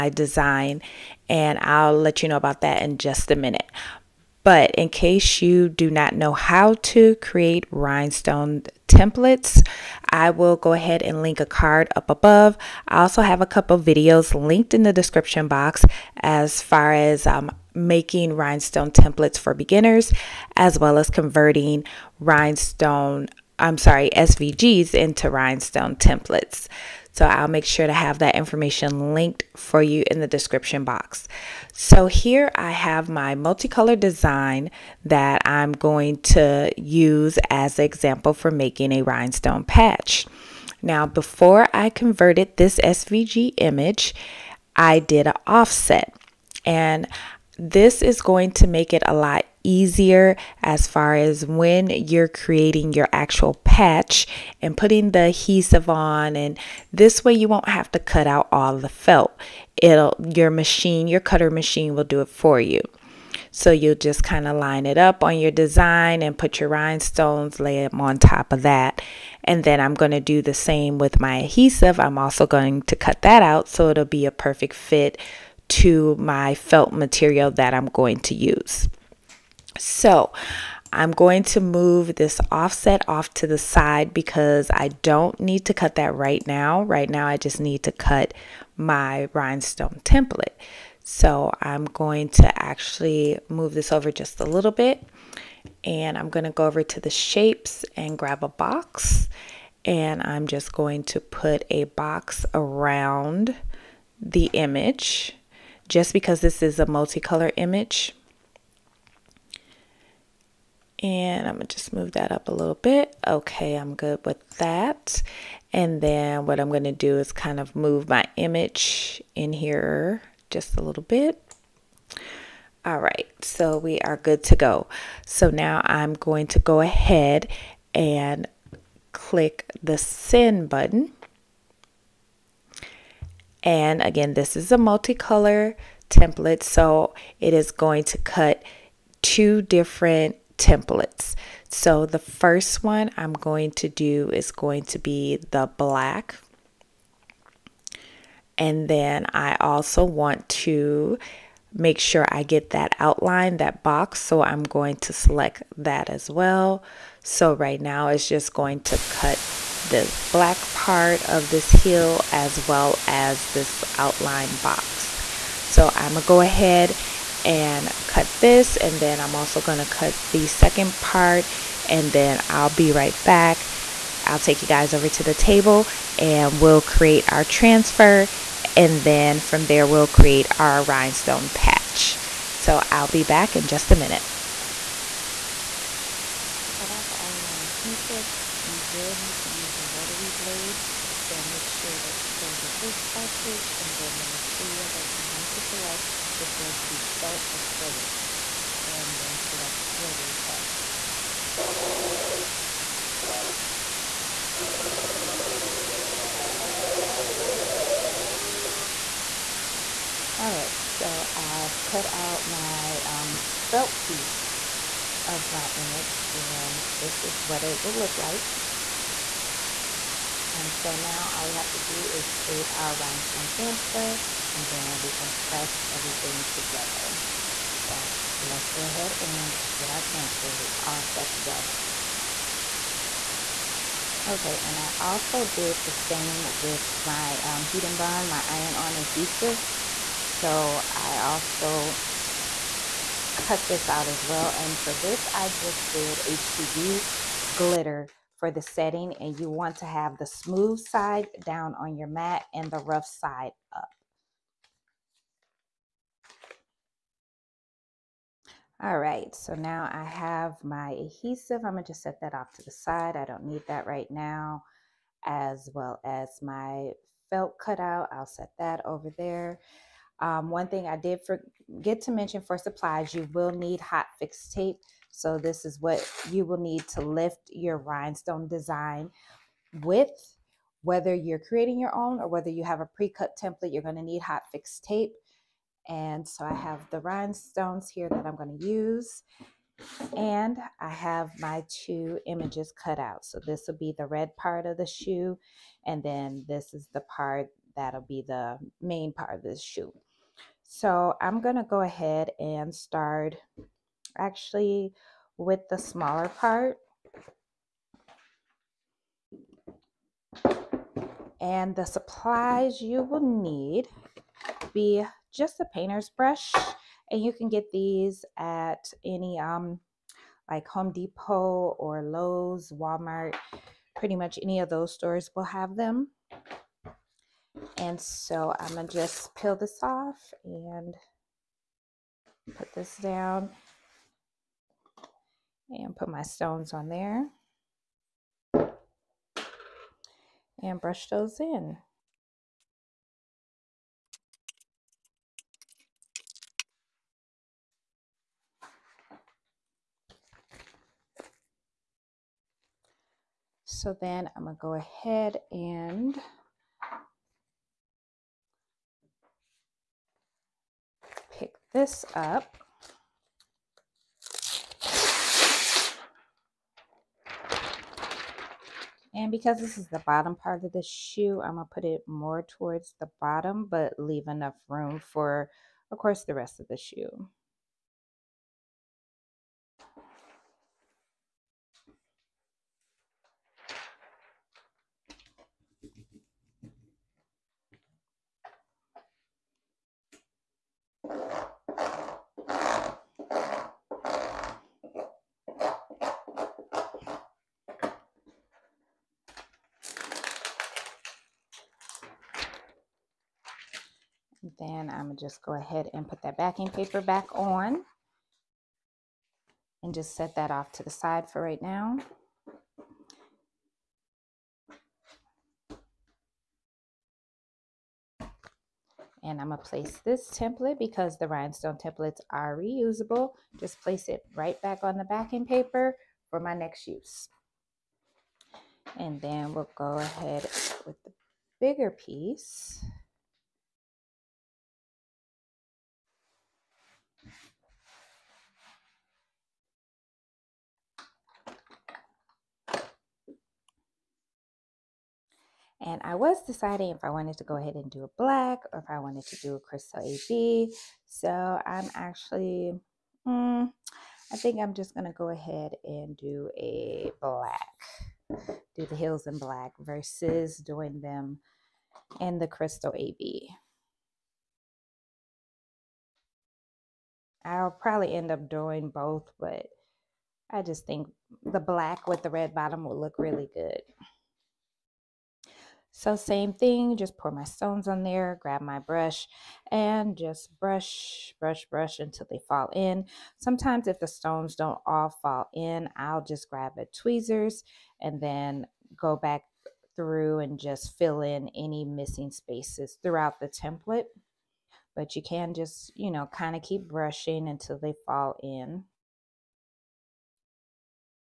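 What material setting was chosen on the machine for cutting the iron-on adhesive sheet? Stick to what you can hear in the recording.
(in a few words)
HTV glitter.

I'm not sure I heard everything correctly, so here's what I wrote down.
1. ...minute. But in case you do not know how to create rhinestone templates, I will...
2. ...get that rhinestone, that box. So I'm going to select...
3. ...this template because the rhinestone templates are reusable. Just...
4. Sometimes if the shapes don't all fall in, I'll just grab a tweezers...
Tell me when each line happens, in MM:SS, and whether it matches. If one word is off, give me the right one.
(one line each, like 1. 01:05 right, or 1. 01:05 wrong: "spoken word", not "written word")
1. 00:03 right
2. 02:32 wrong: "outline", not "rhinestone"
3. 06:59 right
4. 08:03 wrong: "stones", not "shapes".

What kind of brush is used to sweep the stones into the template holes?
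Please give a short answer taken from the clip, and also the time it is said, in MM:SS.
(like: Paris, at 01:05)
Painter's brush, at 05:15.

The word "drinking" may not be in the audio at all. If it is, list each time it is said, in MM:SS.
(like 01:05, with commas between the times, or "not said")
not said.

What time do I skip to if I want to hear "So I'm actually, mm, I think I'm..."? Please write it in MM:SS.
07:31.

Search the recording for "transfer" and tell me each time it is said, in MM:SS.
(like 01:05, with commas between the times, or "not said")
02:57, 03:43, 03:50.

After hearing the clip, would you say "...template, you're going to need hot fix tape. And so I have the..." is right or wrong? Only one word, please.
right.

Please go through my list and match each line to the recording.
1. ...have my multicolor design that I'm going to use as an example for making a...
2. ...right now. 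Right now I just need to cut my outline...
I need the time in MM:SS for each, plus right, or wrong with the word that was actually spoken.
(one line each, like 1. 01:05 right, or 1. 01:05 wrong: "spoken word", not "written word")
1. 00:32 right
2. 01:26 wrong: "rhinestone", not "outline".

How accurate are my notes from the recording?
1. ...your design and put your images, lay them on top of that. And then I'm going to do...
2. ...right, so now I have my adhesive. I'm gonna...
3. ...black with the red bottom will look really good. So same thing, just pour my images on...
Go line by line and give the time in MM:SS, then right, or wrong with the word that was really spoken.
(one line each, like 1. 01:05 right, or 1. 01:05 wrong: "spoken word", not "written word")
1. 01:05 wrong: "rhinestones", not "images"
2. 04:18 right
3. 07:51 wrong: "stones", not "images".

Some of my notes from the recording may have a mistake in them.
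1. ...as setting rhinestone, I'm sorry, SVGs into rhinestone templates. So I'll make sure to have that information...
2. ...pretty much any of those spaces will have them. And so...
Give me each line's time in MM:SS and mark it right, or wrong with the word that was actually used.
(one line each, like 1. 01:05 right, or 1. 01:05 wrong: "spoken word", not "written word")
1. 00:20 wrong: "converting", not "setting"
2. 05:23 wrong: "stores", not "spaces".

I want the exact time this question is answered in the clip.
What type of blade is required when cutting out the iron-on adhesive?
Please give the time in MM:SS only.
03:09.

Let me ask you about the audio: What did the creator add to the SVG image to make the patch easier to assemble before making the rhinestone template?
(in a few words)
An offset.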